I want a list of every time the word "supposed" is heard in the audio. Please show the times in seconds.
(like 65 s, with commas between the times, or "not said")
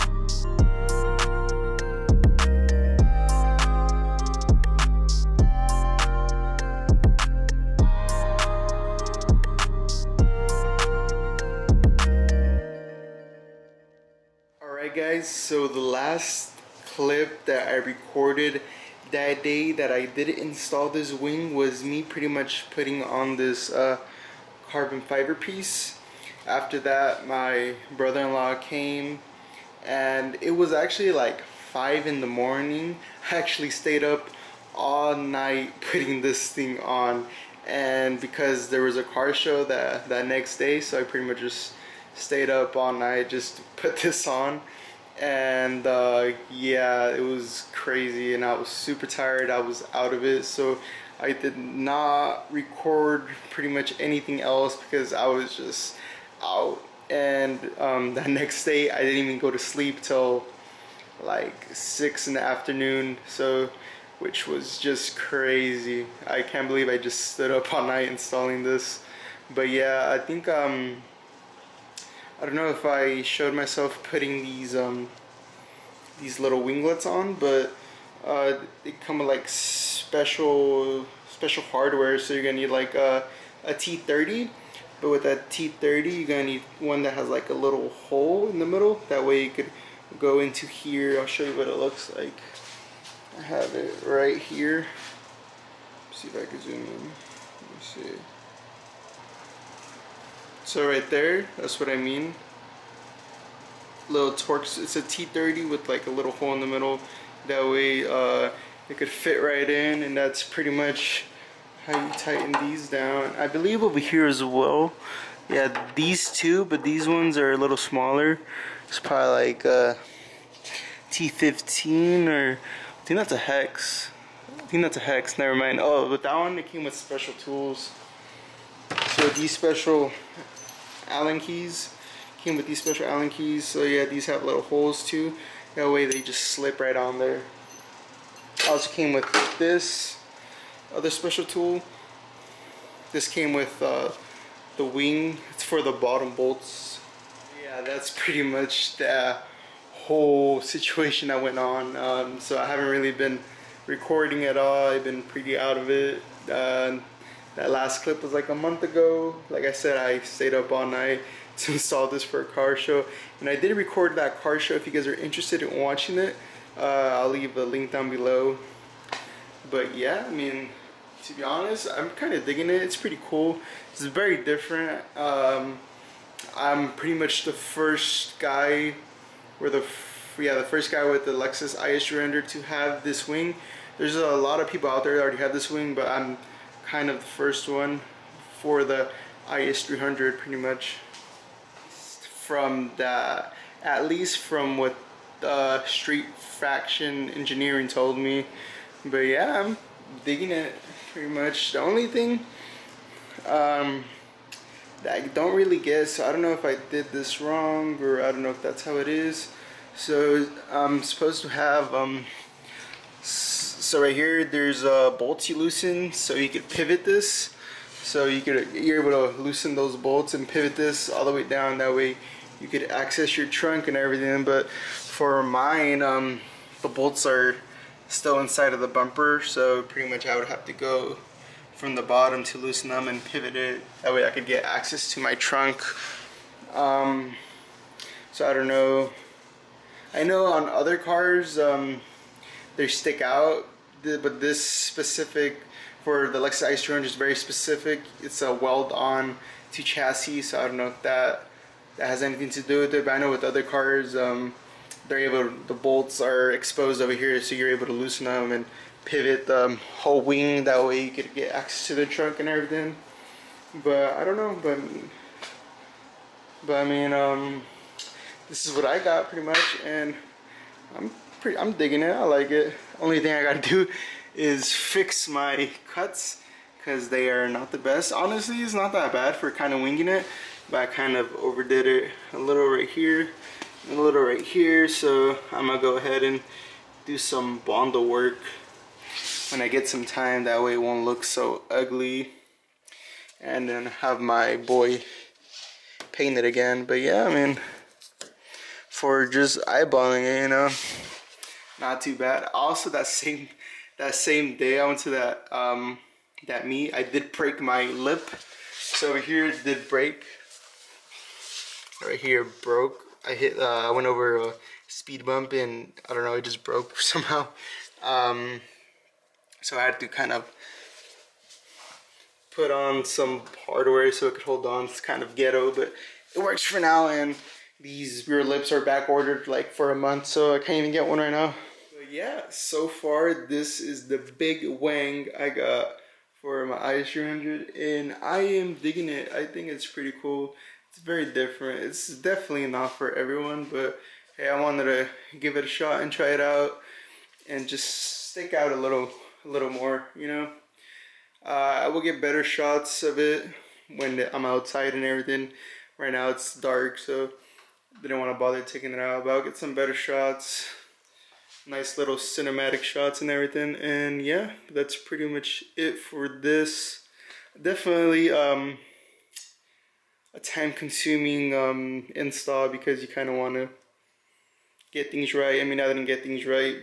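211 s.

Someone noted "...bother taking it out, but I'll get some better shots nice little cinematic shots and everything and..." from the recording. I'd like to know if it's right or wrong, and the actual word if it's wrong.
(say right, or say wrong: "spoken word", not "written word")
right.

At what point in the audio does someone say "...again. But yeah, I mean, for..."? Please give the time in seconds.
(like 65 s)
296 s.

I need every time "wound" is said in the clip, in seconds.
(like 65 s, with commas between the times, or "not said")
not said.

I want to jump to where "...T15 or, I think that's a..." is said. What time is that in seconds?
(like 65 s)
121 s.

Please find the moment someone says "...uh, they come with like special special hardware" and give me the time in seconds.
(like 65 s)
78 s.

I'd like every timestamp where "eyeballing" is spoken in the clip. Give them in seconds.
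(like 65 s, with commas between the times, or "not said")
299 s.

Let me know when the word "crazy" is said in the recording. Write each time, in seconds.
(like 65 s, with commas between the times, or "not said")
47 s, 65 s.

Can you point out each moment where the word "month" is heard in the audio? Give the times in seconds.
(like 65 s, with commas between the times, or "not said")
158 s, 329 s.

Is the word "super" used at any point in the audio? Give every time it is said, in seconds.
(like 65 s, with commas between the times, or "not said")
48 s.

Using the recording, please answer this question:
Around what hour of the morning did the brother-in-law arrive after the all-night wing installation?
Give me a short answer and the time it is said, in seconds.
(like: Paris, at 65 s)
5, at 31 s.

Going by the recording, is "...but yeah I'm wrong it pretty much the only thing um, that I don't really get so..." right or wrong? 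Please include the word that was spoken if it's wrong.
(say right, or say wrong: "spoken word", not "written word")
wrong: "digging", not "wrong".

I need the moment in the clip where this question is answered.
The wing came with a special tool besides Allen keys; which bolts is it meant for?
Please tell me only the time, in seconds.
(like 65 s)
145 s.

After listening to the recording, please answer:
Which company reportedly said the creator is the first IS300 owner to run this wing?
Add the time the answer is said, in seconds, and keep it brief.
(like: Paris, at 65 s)
Street Faction Engineering, at 195 s.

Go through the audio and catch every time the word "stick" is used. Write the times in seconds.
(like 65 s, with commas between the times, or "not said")
242 s, 348 s.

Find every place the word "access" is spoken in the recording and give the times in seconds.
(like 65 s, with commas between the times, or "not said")
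222 s, 234 s, 261 s.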